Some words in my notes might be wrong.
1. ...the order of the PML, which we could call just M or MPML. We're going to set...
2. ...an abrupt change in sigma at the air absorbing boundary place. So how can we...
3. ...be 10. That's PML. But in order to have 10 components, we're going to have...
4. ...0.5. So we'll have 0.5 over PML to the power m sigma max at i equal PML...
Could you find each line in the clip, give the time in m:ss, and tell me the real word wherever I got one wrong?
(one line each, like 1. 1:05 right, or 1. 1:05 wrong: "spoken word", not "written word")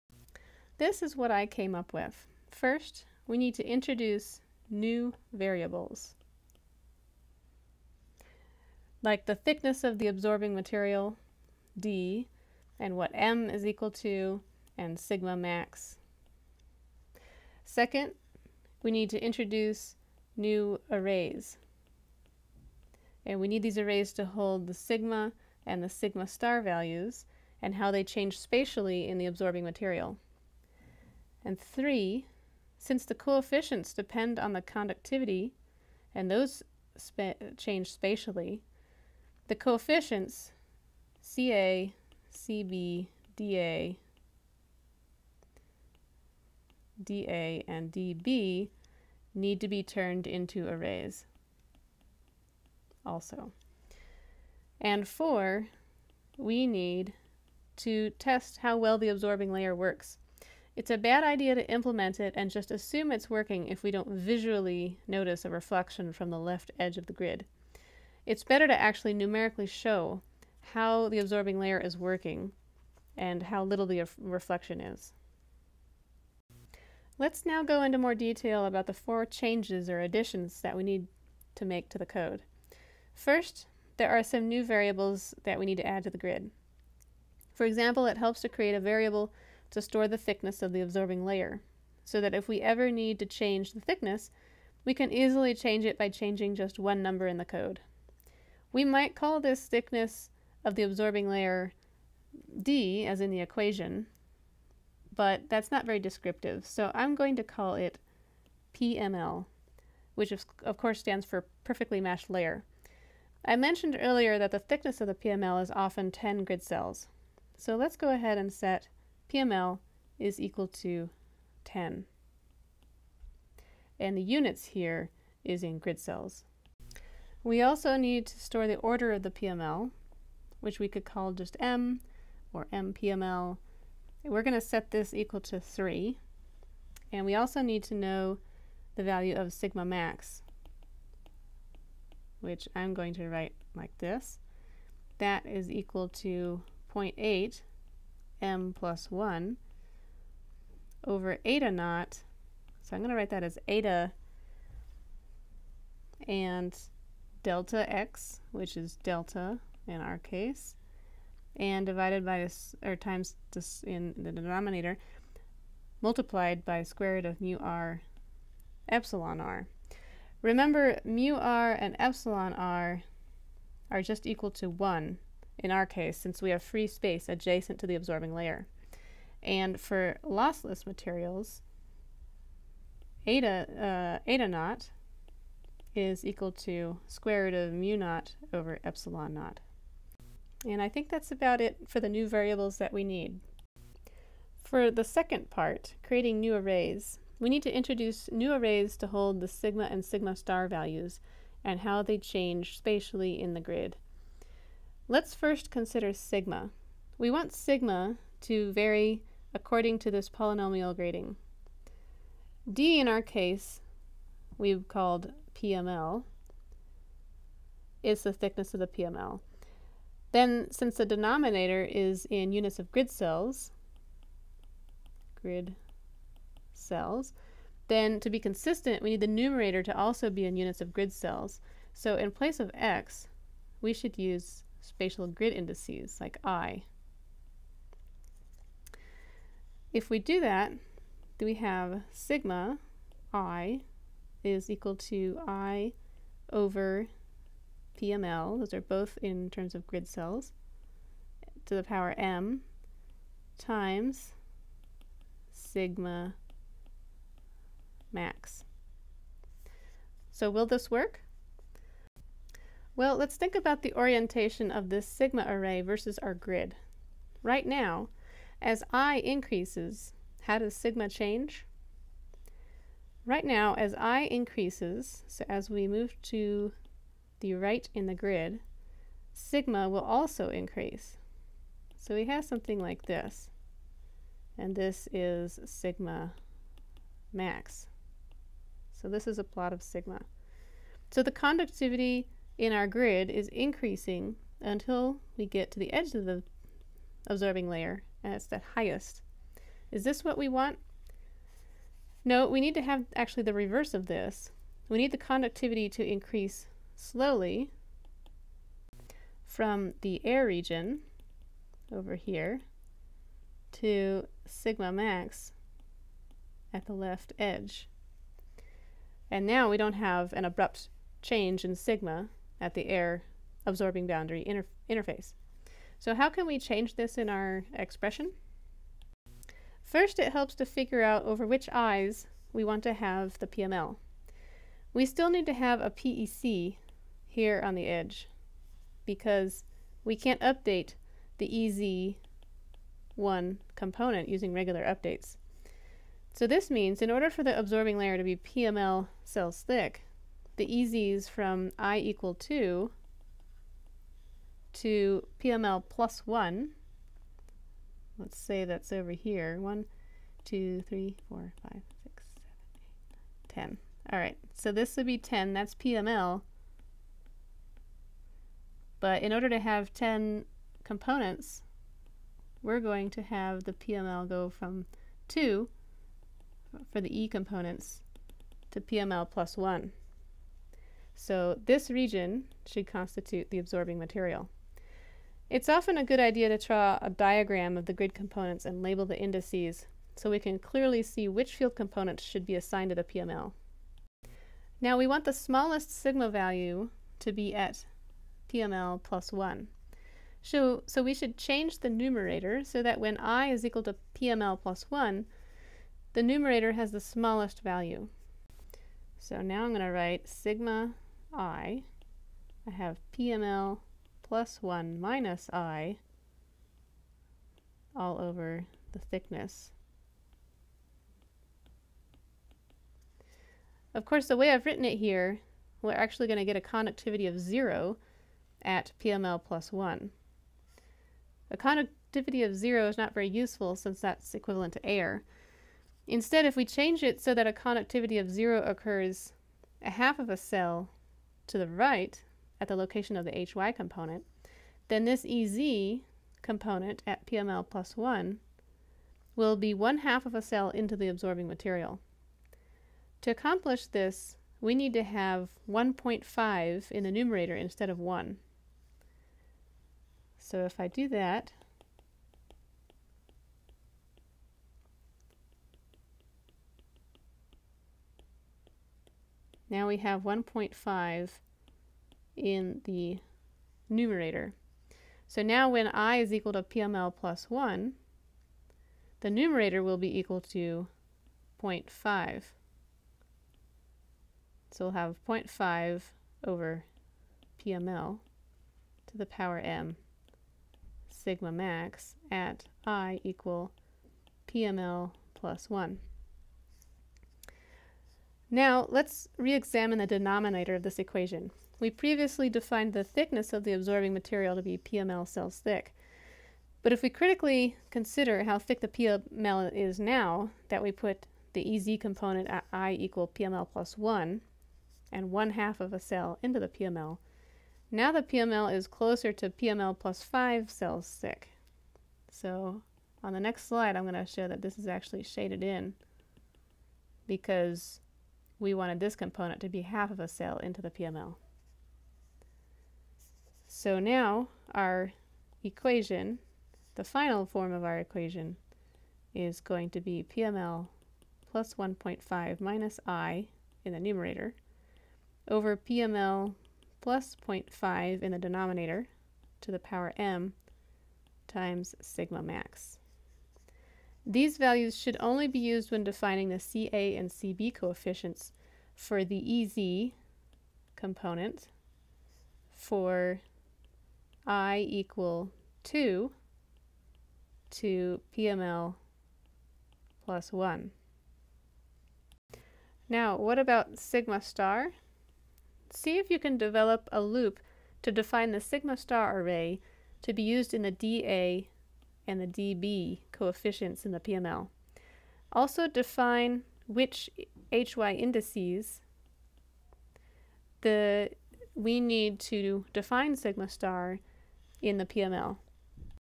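1. 2:08 right
2. 5:20 wrong: "interface", not "place"
3. 6:05 right
4. 8:01 right.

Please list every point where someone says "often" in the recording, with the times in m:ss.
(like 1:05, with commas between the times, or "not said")
1:55, 6:25.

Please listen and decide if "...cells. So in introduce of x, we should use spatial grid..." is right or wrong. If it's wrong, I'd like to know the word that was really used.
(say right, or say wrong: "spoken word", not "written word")
wrong: "place", not "introduce".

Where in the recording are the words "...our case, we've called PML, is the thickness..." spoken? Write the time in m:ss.
3:33.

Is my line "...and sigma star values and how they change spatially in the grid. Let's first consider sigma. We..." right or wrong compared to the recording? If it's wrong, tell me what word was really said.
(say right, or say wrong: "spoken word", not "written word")
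right.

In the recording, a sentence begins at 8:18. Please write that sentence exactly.
Now let's re-examine the denominator of this equation.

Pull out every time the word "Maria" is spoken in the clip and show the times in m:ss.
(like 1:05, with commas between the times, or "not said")
not said.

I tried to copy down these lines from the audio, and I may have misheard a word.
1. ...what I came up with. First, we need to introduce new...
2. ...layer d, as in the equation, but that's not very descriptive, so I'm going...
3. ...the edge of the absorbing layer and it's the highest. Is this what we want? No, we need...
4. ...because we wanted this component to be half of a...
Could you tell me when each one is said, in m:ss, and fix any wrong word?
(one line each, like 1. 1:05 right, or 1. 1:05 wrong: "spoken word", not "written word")
1. 0:01 right
2. 1:41 right
3. 4:55 right
4. 8:47 right.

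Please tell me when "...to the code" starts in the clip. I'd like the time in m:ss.
1:21.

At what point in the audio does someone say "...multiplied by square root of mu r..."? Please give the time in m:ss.
2:46.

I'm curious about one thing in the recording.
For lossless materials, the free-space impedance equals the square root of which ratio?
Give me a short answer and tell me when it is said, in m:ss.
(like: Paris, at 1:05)
mu naught over epsilon naught, at 3:07.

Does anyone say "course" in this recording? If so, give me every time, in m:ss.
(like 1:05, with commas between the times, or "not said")
1:50, 7:04.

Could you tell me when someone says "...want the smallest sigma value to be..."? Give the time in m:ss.
6:35.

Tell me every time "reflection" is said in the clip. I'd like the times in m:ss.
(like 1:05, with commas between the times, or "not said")
1:05, 1:14.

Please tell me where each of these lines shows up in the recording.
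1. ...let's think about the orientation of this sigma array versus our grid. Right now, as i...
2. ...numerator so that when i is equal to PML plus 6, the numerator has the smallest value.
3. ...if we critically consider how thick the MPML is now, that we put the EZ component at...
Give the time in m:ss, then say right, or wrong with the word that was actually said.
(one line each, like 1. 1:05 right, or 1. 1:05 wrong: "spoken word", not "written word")
1. 4:23 right
2. 6:41 wrong: "1", not "6"
3. 8:26 wrong: "PML", not "MPML".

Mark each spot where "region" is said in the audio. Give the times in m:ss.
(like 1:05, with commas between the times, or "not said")
5:10, 6:21.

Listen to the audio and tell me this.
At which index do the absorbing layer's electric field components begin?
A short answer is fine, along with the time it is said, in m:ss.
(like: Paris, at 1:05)
2, at 5:50.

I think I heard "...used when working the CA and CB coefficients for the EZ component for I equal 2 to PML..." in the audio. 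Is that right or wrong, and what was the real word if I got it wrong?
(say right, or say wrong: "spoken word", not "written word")
wrong: "defining", not "working".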